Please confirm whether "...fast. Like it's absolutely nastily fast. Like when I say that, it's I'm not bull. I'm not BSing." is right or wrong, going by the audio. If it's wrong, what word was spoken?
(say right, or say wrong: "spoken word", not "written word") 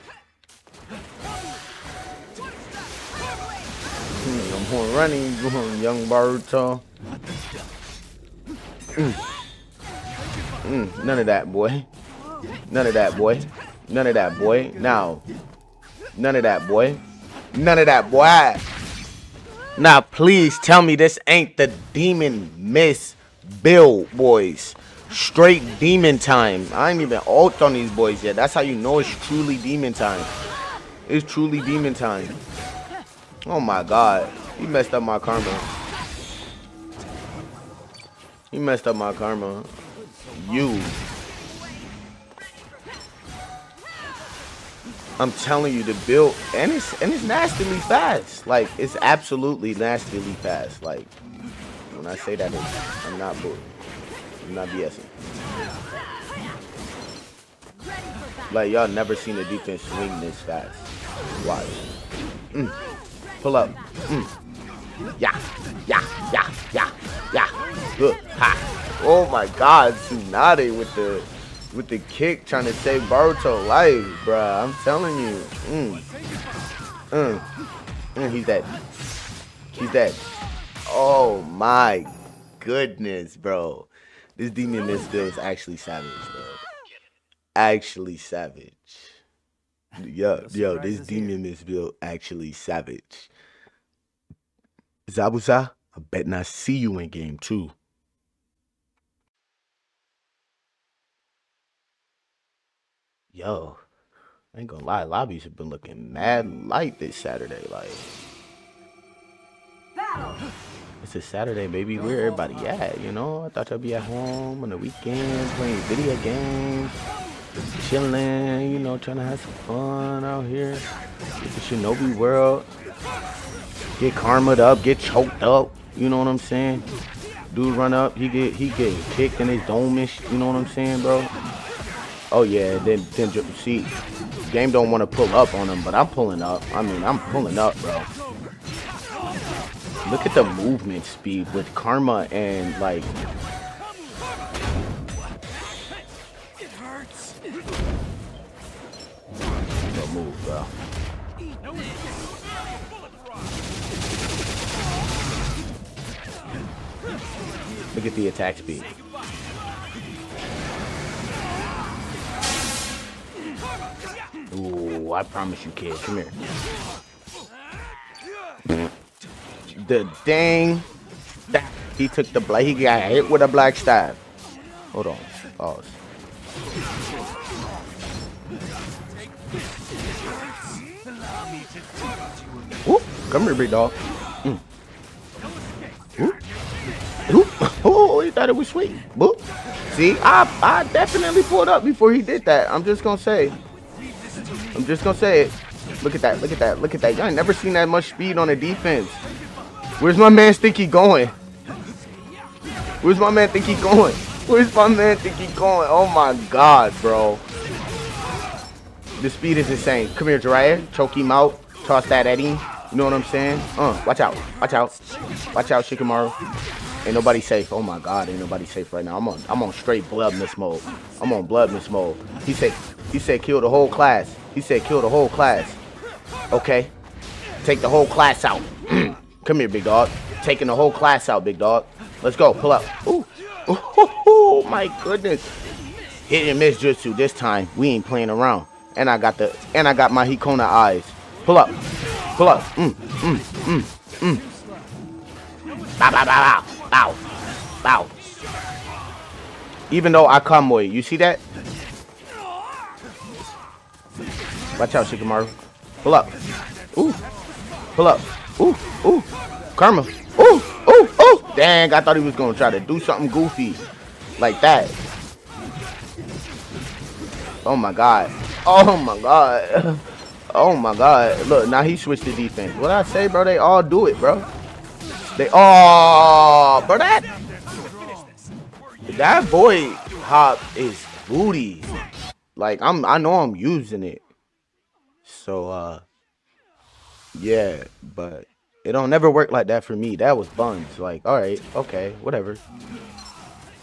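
right.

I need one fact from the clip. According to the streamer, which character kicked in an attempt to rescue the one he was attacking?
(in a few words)
Tsunade.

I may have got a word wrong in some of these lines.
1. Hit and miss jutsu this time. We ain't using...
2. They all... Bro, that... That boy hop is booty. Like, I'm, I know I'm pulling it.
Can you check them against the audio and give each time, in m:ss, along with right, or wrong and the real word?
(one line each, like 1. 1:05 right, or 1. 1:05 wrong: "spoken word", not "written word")
1. 3:56 wrong: "playing", not "using"
2. 4:35 wrong: "using", not "pulling".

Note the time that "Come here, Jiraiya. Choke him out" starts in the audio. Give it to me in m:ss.
3:30.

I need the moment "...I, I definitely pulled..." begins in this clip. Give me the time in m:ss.
3:10.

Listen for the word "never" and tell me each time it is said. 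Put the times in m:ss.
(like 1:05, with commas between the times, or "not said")
0:58, 3:17, 4:49.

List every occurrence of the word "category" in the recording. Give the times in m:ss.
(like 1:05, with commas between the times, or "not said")
not said.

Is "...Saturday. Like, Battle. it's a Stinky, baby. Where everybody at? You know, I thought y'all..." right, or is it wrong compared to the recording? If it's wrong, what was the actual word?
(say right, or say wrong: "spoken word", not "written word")
wrong: "Saturday", not "Stinky".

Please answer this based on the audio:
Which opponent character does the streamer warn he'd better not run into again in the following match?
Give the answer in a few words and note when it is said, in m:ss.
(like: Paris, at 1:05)
Zabuza, at 1:35.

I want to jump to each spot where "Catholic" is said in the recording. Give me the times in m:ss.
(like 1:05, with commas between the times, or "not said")
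not said.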